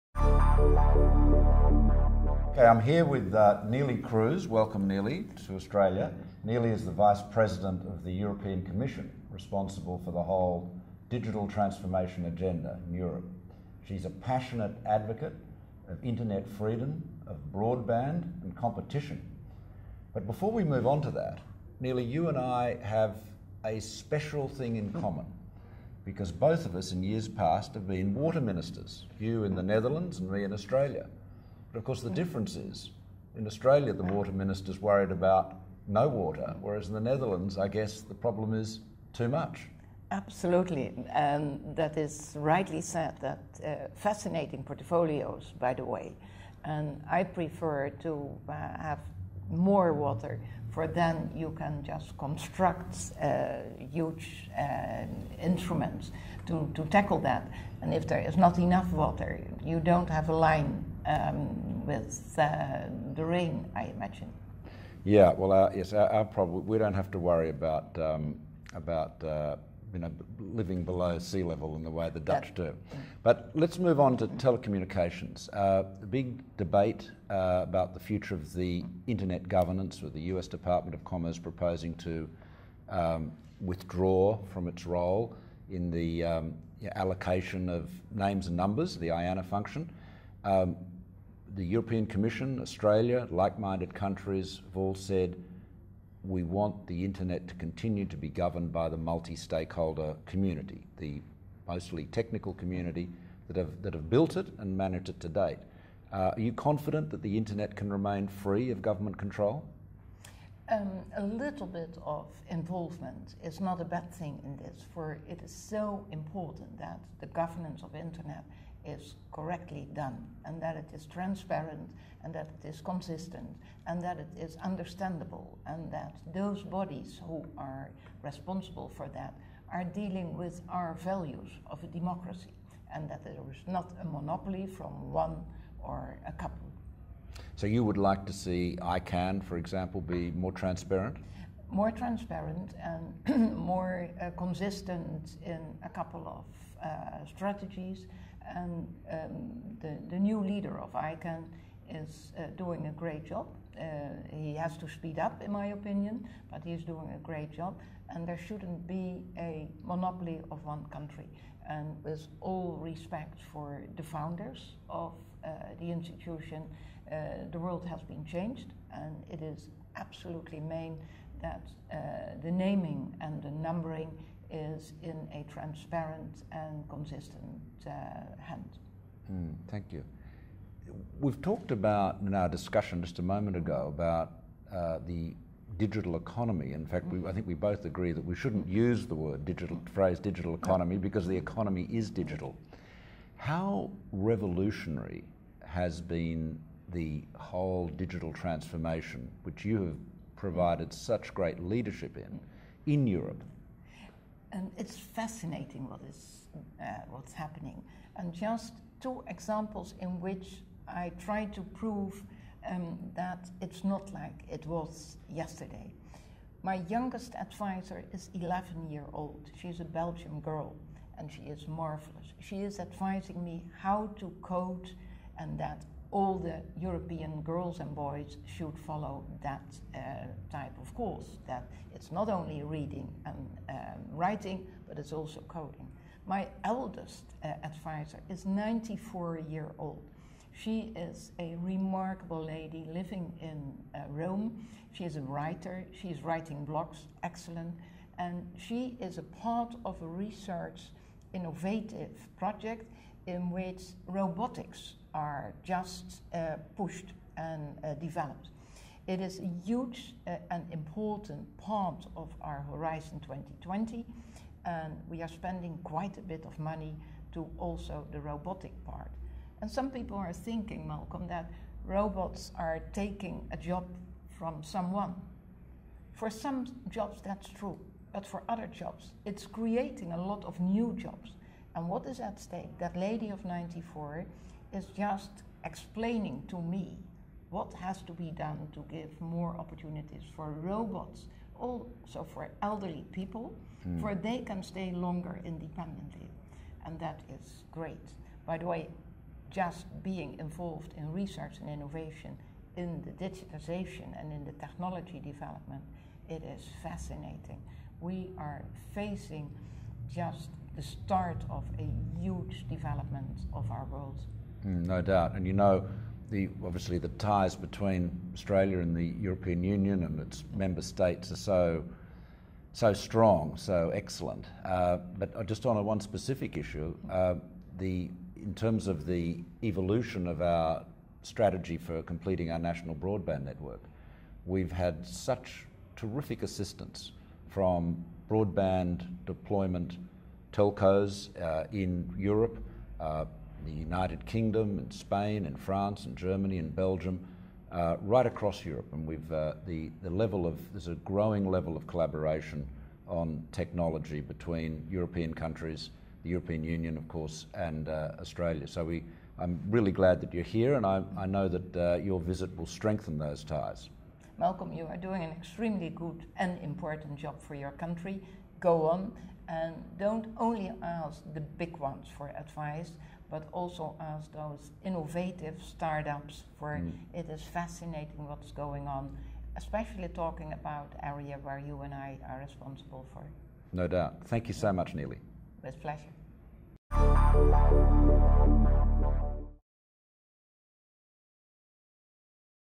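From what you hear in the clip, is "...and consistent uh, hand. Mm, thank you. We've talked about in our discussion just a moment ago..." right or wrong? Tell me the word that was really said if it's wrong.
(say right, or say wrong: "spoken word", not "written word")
right.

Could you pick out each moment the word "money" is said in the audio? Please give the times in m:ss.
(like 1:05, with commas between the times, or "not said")
4:26.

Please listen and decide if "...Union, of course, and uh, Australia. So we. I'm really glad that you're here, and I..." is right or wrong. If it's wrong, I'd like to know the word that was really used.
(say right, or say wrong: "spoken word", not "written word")
right.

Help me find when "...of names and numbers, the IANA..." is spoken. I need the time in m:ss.
1:27.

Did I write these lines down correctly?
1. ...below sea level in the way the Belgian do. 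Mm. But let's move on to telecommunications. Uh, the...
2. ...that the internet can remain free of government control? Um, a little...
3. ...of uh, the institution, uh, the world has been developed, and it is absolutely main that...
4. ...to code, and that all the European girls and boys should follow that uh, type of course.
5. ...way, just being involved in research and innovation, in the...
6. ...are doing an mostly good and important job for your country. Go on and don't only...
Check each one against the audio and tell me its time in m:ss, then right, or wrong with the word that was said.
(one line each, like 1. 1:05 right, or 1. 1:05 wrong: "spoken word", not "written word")
1. 1:10 wrong: "Dutch", not "Belgian"
2. 1:47 right
3. 2:44 wrong: "changed", not "developed"
4. 3:44 right
5. 4:58 right
6. 6:04 wrong: "extremely", not "mostly".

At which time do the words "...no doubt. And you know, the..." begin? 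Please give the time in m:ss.
5:14.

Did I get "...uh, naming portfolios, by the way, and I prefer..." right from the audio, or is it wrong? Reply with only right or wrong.
wrong.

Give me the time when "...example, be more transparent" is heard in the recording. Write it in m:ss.
2:19.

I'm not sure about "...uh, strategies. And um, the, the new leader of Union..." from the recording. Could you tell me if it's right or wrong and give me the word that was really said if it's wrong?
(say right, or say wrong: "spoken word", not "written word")
wrong: "ICANN", not "Union".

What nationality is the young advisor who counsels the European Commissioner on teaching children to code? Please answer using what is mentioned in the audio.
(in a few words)
Belgian.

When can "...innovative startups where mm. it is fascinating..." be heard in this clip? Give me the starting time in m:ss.
6:14.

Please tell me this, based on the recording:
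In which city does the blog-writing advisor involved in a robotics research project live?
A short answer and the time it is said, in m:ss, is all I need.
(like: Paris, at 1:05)
Rome, at 4:04.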